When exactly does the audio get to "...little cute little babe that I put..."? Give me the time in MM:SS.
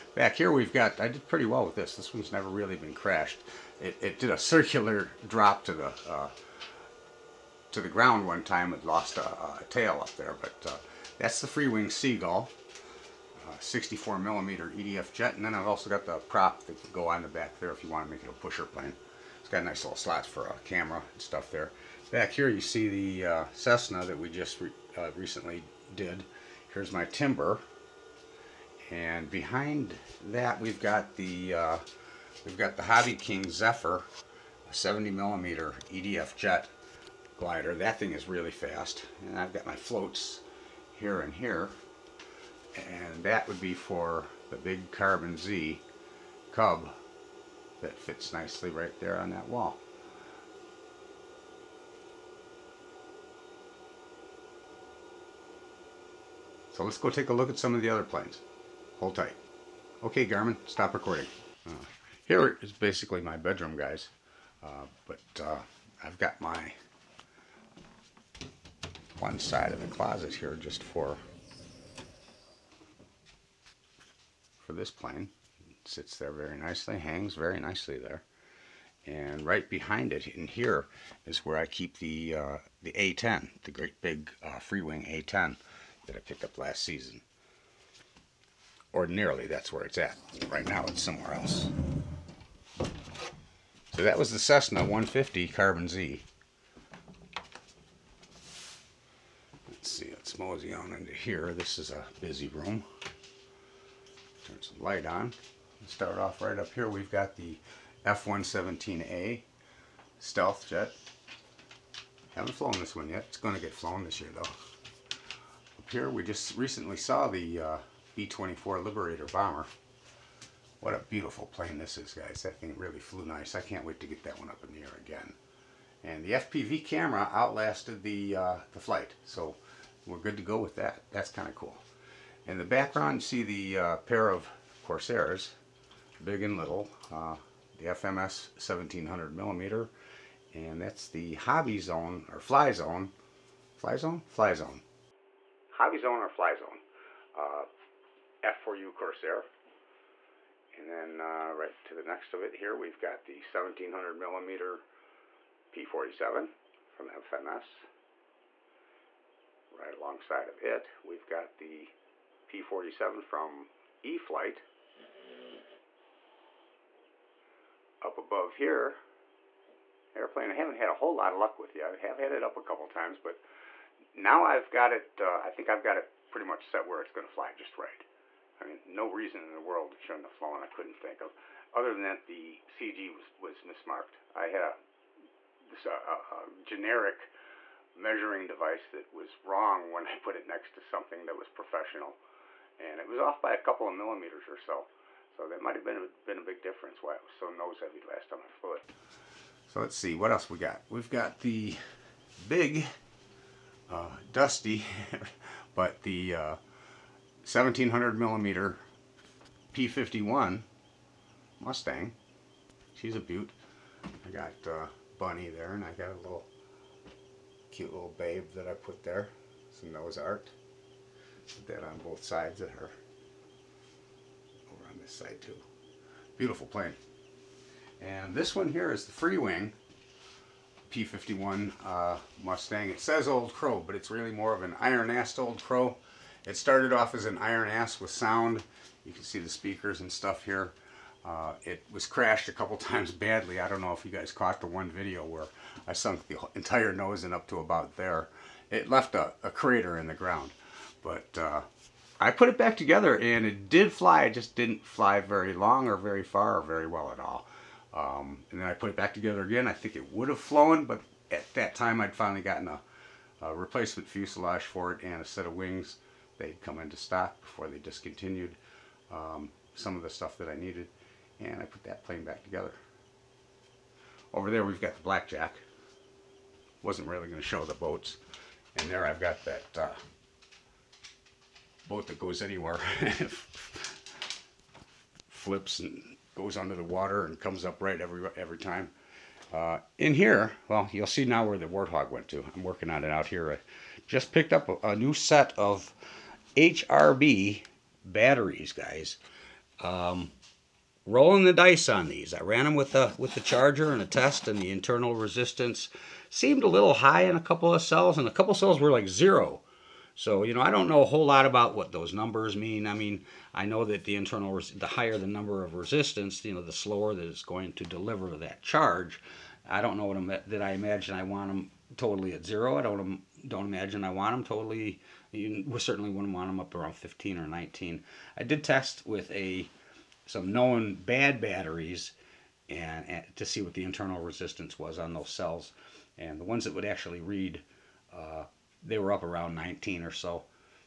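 03:36.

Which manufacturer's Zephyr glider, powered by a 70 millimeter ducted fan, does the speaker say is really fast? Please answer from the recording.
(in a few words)
Hobby King.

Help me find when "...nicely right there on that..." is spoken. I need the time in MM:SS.
00:48.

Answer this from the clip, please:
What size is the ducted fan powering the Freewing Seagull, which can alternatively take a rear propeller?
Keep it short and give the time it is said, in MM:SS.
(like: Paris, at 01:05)
64 millimeter, at 00:13.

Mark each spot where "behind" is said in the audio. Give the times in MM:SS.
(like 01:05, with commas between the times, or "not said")
00:29, 01:19.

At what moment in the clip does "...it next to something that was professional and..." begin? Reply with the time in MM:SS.
03:10.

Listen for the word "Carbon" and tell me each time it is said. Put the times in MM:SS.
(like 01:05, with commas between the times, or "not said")
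00:44, 01:35.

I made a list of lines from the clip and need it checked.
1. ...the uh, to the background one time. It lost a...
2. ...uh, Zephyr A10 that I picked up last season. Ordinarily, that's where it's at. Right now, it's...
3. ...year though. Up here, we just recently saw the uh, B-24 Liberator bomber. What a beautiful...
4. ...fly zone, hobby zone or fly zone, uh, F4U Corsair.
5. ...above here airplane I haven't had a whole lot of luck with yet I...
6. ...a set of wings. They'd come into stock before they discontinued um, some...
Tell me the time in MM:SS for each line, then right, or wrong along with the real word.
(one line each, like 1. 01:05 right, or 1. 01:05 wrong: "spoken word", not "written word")
1. 00:05 wrong: "ground", not "background"
2. 01:24 wrong: "Freewing", not "Zephyr"
3. 01:54 right
4. 02:24 right
5. 02:48 right
6. 04:25 right.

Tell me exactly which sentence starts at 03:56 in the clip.
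It started off as an iron ass with sound.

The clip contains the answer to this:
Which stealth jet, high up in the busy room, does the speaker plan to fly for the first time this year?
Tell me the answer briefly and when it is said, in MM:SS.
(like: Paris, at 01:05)
F-117A, at 01:48.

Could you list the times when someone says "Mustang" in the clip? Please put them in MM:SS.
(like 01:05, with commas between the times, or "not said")
03:31, 03:52.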